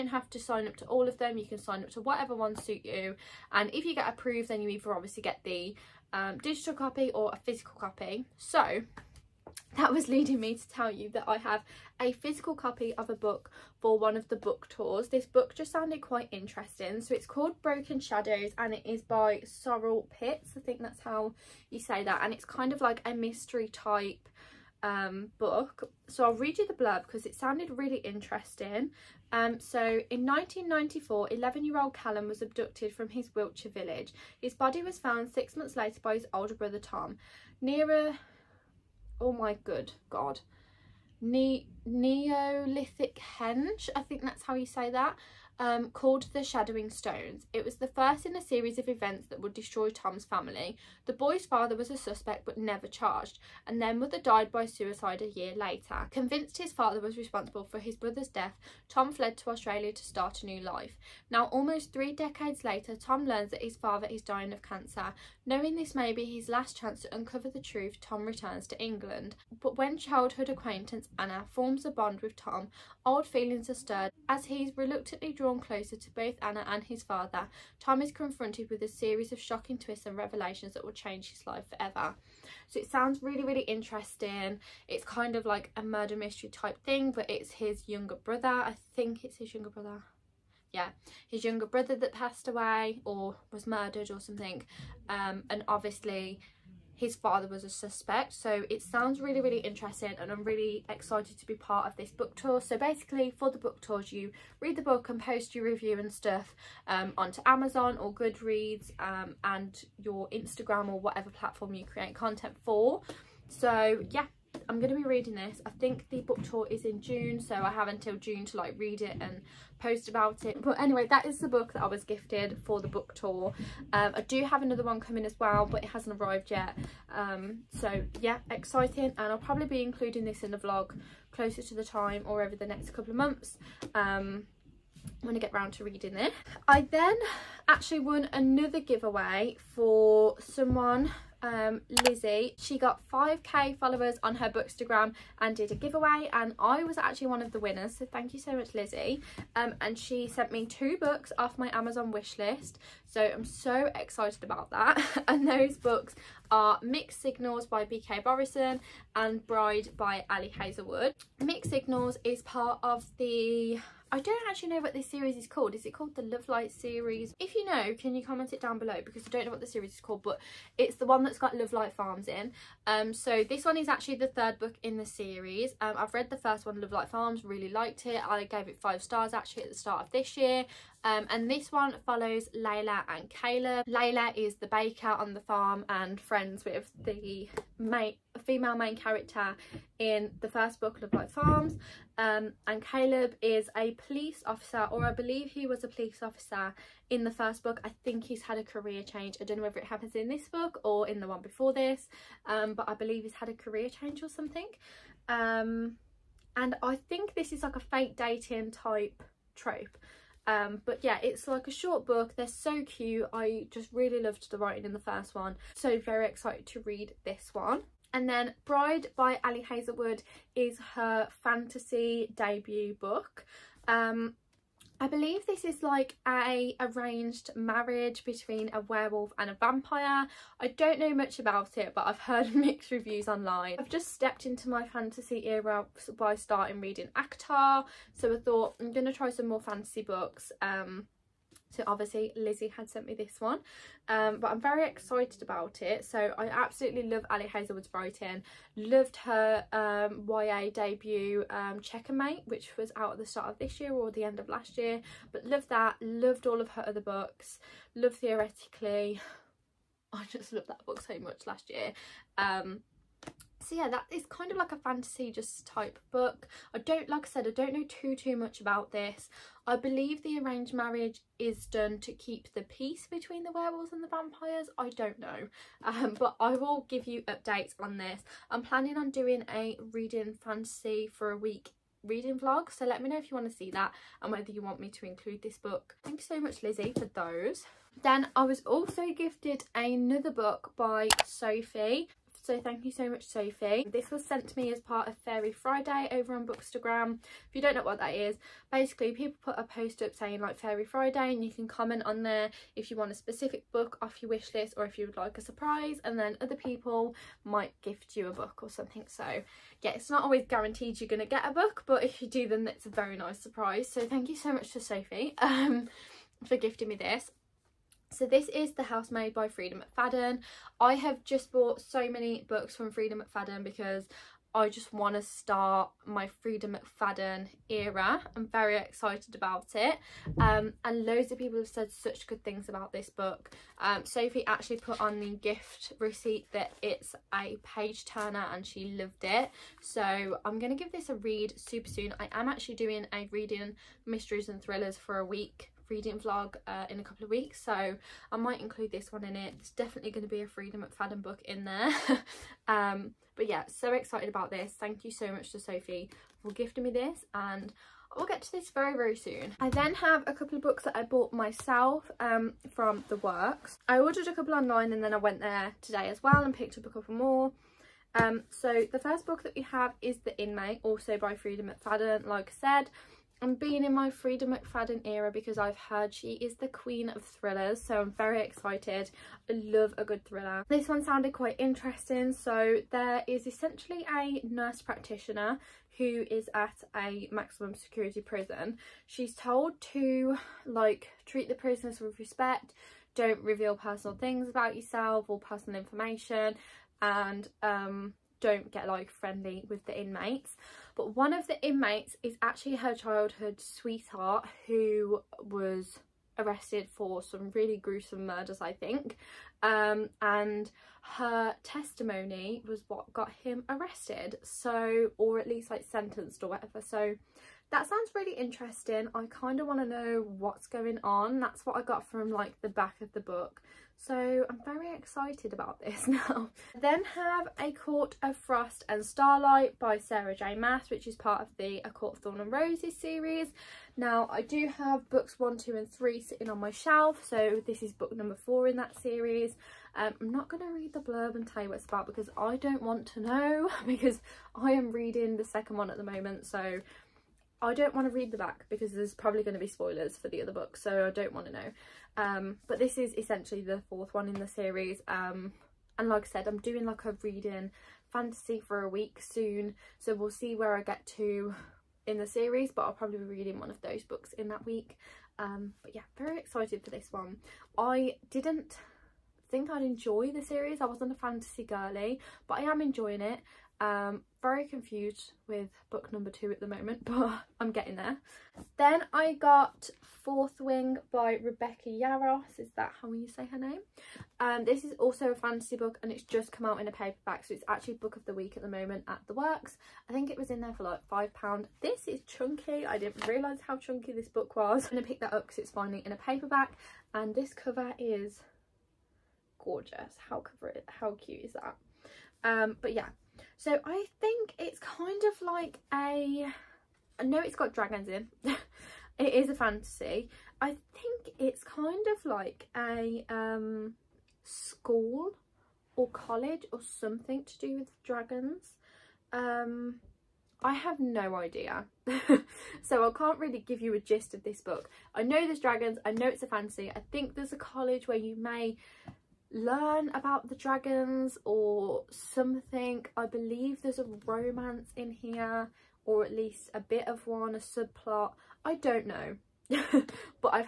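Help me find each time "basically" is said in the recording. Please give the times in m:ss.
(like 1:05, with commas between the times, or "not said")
1:42, 4:58.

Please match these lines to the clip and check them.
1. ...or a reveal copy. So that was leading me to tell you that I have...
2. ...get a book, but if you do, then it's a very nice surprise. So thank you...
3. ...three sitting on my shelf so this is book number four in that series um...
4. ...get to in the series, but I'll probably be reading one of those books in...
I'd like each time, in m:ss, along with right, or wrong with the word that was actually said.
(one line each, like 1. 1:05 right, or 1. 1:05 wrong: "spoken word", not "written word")
1. 0:07 wrong: "physical", not "reveal"
2. 5:11 right
3. 7:15 right
4. 7:40 right.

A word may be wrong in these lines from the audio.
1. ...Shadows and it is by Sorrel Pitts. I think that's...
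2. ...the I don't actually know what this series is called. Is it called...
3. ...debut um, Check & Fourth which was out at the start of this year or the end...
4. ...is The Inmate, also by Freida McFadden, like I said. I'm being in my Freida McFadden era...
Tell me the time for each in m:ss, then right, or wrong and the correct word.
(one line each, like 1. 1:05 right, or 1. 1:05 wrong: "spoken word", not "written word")
1. 0:18 right
2. 2:43 right
3. 4:10 wrong: "Mate", not "Fourth"
4. 6:10 right.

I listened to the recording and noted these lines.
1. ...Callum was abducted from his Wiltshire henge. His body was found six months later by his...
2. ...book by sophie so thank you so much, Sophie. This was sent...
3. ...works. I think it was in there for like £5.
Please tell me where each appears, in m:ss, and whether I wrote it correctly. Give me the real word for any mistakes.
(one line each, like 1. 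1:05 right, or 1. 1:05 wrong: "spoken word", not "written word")
1. 0:31 wrong: "village", not "henge"
2. 4:50 right
3. 8:09 right.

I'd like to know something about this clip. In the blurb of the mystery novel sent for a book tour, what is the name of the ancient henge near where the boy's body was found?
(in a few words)
the Shadowing Stones.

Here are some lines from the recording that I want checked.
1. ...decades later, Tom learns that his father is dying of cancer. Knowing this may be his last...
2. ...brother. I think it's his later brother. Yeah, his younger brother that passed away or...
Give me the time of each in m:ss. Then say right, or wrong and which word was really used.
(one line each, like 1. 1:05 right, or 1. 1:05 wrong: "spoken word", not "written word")
1. 1:02 right
2. 1:28 wrong: "younger", not "later".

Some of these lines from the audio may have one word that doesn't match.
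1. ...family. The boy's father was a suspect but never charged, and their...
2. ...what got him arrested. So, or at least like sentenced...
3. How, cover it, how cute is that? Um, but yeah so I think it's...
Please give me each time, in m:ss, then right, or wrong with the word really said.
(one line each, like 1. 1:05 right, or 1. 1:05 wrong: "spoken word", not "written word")
1. 0:50 right
2. 6:52 right
3. 8:20 right.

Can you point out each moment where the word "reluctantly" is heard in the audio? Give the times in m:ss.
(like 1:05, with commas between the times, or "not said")
1:14.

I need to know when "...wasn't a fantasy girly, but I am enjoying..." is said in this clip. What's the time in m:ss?
7:50.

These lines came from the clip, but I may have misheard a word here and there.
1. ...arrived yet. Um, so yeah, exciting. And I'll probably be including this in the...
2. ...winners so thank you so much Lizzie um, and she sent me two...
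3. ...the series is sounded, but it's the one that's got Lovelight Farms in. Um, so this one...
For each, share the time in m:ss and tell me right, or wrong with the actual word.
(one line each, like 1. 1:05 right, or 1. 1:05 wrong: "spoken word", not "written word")
1. 2:06 right
2. 2:27 right
3. 2:49 wrong: "called", not "sounded".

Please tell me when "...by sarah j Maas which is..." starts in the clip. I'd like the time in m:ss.
7:09.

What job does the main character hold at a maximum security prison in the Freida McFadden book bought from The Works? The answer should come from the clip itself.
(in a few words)
nurse practitioner.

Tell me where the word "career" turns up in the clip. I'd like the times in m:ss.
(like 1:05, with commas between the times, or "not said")
3:18, 3:23.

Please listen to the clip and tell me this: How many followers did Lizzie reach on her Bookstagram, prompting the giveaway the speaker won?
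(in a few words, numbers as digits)
5k.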